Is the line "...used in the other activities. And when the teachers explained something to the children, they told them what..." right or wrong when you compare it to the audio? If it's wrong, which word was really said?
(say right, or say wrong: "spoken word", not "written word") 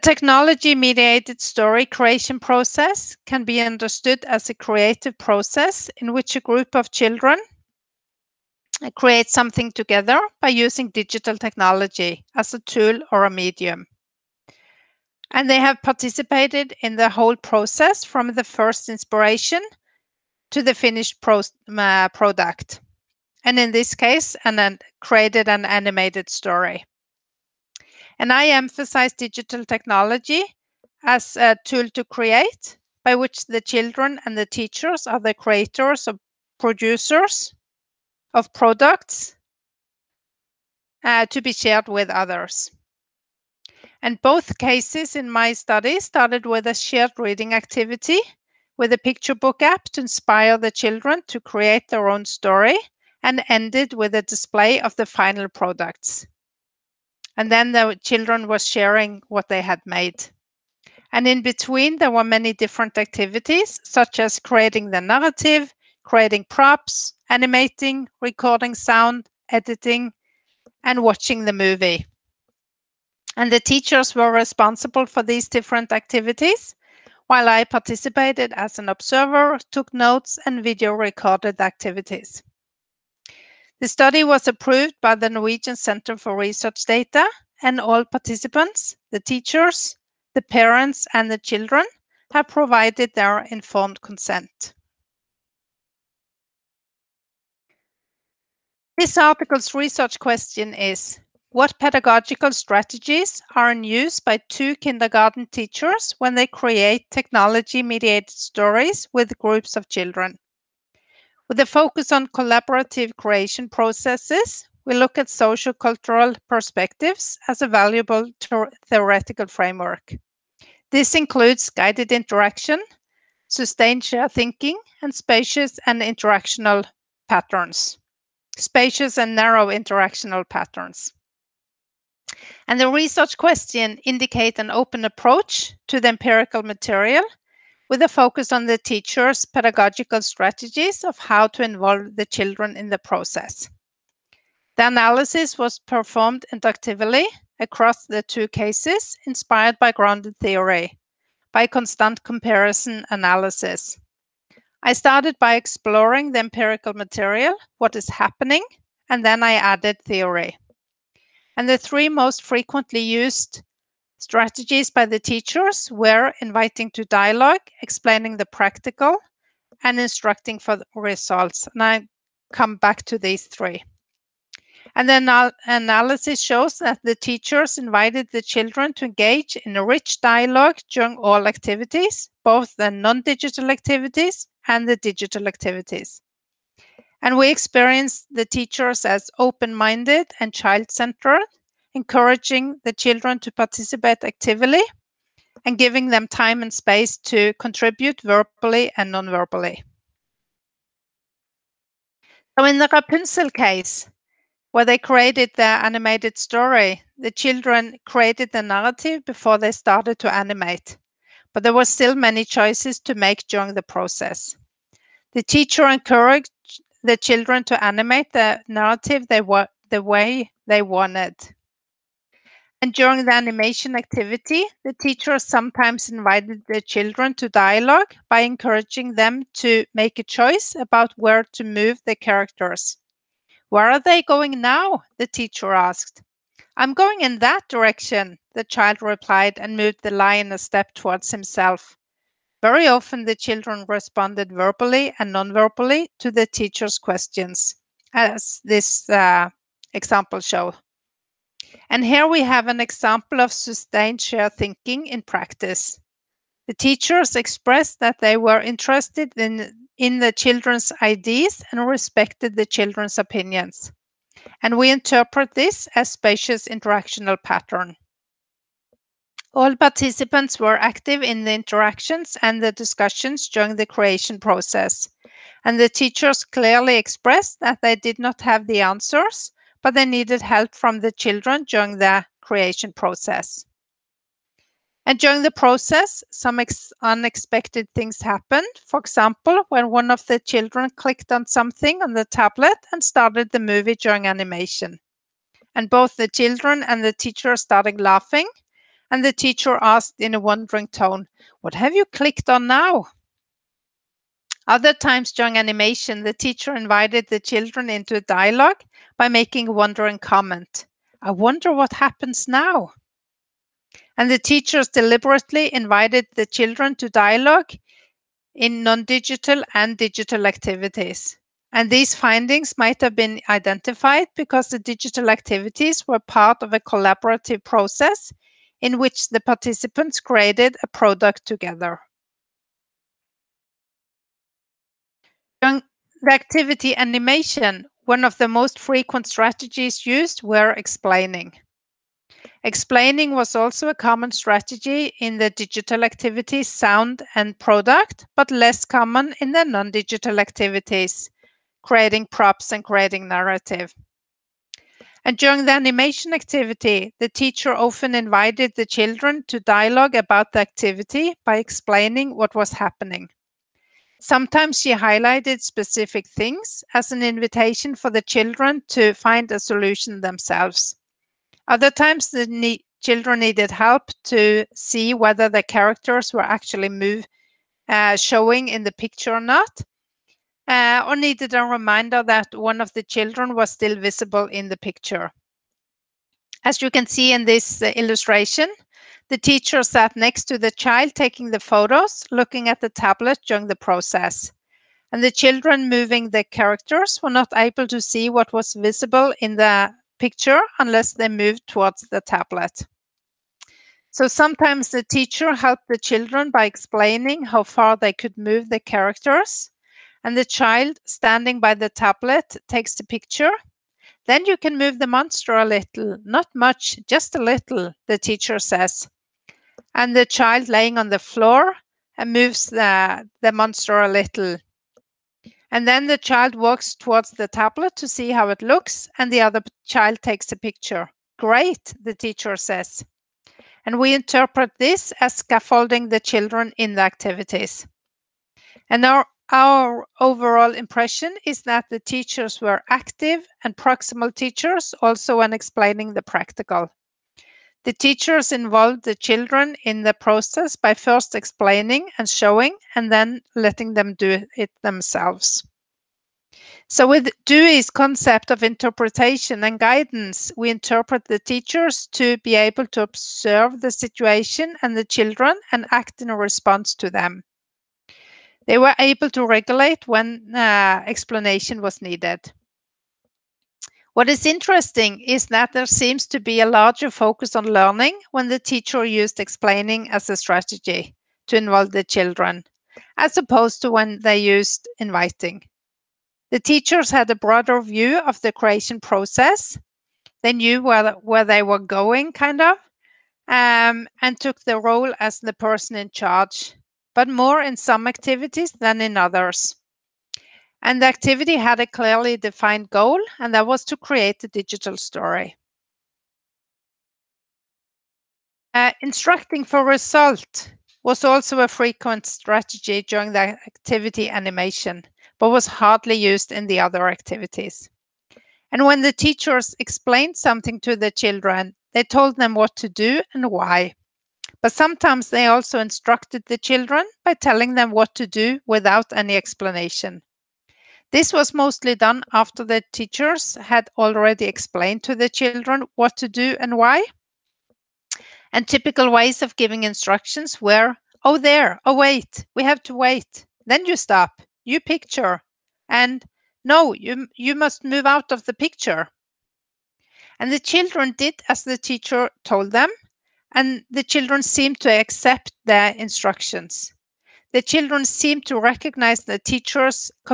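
right.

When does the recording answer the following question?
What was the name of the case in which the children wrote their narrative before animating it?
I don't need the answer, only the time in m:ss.
3:22.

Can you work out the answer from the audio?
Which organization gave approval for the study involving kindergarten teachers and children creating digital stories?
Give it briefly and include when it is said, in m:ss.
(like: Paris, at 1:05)
Norwegian Center for Research Data, at 1:25.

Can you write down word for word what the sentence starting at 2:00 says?
This includes guided interaction, sustained share thinking, and spacious and interactional patterns spacious and narrow interactional patterns.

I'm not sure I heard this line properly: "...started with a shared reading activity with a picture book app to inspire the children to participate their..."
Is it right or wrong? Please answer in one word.
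wrong.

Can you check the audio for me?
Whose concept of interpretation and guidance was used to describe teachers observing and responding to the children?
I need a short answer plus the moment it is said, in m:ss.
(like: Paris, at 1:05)
Dewey, at 7:37.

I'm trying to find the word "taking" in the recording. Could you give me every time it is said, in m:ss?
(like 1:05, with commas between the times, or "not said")
6:31.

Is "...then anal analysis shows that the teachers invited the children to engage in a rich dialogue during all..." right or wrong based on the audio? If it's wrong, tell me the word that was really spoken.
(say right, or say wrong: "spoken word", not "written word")
right.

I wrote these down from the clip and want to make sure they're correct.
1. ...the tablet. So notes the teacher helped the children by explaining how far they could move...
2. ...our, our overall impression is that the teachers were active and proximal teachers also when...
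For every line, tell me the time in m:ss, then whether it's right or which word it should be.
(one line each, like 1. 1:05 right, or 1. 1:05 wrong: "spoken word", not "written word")
1. 6:42 wrong: "sometimes", not "notes"
2. 7:19 right.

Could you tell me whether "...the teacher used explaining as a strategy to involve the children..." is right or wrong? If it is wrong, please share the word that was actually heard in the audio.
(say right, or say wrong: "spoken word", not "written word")
right.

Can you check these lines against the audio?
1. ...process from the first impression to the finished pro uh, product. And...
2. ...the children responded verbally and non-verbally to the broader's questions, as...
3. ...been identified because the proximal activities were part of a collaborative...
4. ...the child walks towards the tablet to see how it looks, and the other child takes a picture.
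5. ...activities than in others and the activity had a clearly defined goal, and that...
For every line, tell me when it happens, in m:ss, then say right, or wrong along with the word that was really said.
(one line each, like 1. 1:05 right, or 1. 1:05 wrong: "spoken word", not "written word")
1. 0:17 wrong: "inspiration", not "impression"
2. 4:03 wrong: "teacher", not "broader"
3. 5:23 wrong: "digital", not "proximal"
4. 7:06 right
5. 8:18 right.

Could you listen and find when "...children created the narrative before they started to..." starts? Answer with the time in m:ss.
3:27.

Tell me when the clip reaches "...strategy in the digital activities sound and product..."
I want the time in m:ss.
5:44.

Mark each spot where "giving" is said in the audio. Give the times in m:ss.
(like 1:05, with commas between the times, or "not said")
3:15, 8:59.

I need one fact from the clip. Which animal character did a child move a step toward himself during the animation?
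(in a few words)
lion.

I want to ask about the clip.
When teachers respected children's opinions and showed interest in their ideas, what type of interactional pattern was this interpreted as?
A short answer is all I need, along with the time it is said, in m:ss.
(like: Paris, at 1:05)
spacious interactional pattern, at 4:26.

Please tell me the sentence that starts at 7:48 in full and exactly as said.
They were able to regulate when uh, explanation was needed.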